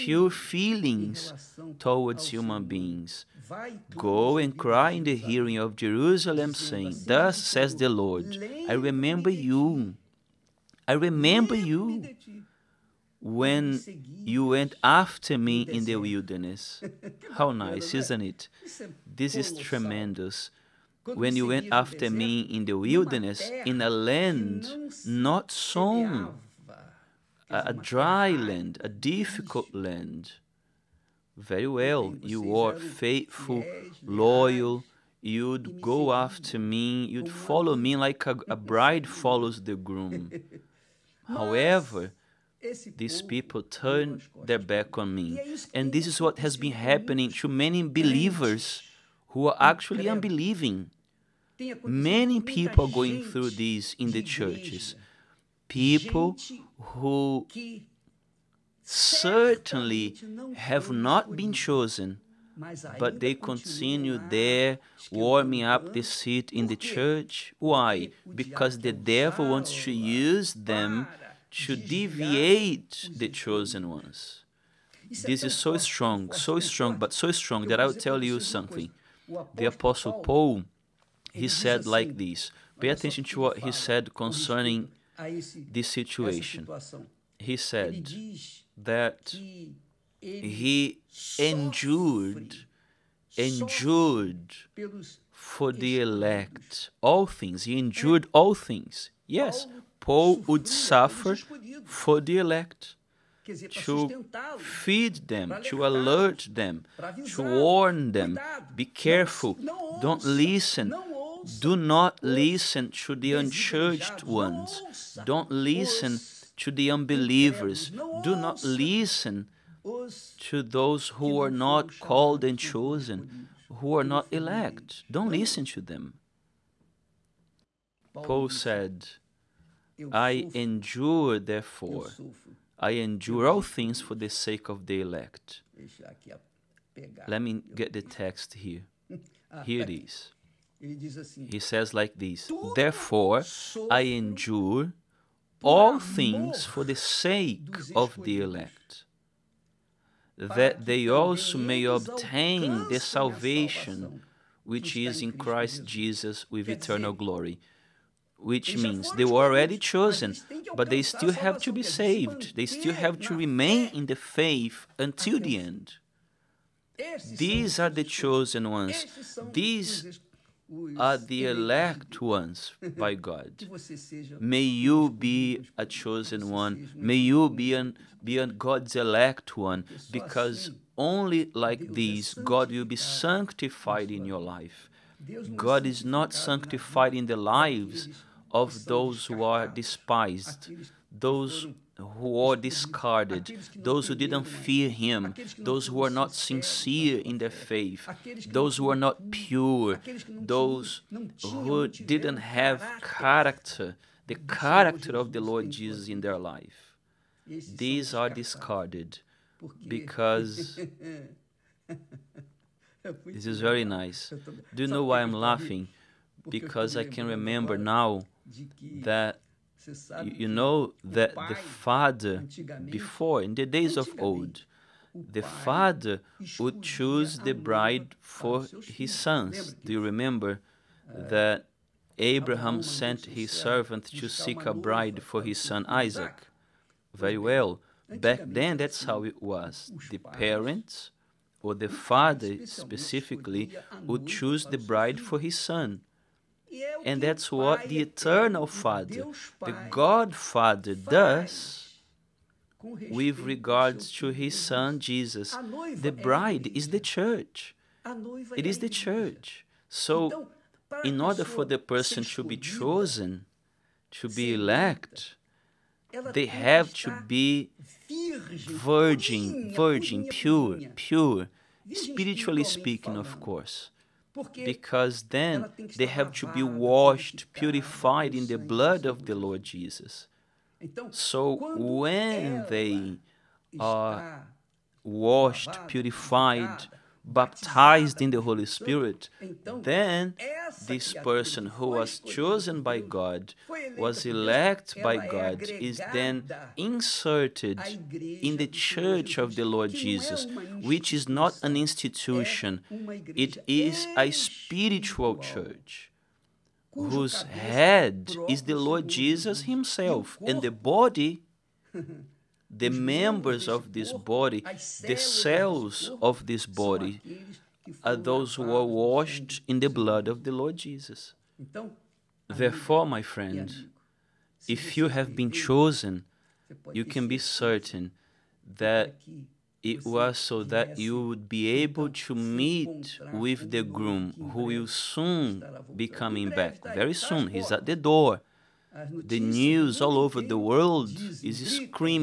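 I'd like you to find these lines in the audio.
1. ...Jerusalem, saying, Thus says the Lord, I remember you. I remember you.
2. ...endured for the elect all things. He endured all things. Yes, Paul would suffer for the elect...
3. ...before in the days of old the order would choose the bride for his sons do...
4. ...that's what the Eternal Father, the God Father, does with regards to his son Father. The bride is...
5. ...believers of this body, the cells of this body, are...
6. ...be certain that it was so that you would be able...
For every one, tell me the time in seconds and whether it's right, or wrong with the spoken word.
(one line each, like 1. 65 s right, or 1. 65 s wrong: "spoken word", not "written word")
1. 5 s right
2. 93 s right
3. 222 s wrong: "father", not "order"
4. 247 s wrong: "Jesus", not "Father"
5. 312 s wrong: "members", not "believers"
6. 327 s right.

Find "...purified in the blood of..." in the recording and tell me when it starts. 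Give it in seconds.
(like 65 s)
277 s.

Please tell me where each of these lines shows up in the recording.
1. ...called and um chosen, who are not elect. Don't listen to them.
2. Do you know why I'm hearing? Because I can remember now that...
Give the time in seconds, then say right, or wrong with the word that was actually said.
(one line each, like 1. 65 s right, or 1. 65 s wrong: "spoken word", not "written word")
1. 122 s right
2. 214 s wrong: "laughing", not "hearing".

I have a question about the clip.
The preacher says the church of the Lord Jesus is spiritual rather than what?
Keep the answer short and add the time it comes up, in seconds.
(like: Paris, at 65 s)
an institution, at 301 s.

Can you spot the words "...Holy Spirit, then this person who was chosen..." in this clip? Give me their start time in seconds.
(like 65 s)
288 s.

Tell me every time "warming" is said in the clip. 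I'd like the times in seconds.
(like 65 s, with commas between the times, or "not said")
65 s.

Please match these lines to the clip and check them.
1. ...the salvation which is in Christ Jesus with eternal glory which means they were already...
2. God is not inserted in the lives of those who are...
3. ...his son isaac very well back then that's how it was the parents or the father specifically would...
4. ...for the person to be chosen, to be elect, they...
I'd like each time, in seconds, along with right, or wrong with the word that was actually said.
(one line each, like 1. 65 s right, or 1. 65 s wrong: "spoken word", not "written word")
1. 152 s right
2. 185 s wrong: "sanctified", not "inserted"
3. 235 s right
4. 261 s right.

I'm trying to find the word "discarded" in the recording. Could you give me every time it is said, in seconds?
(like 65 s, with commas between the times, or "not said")
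192 s, 208 s.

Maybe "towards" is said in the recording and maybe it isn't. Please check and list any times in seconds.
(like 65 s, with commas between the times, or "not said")
1 s.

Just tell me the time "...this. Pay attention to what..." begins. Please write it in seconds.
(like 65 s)
82 s.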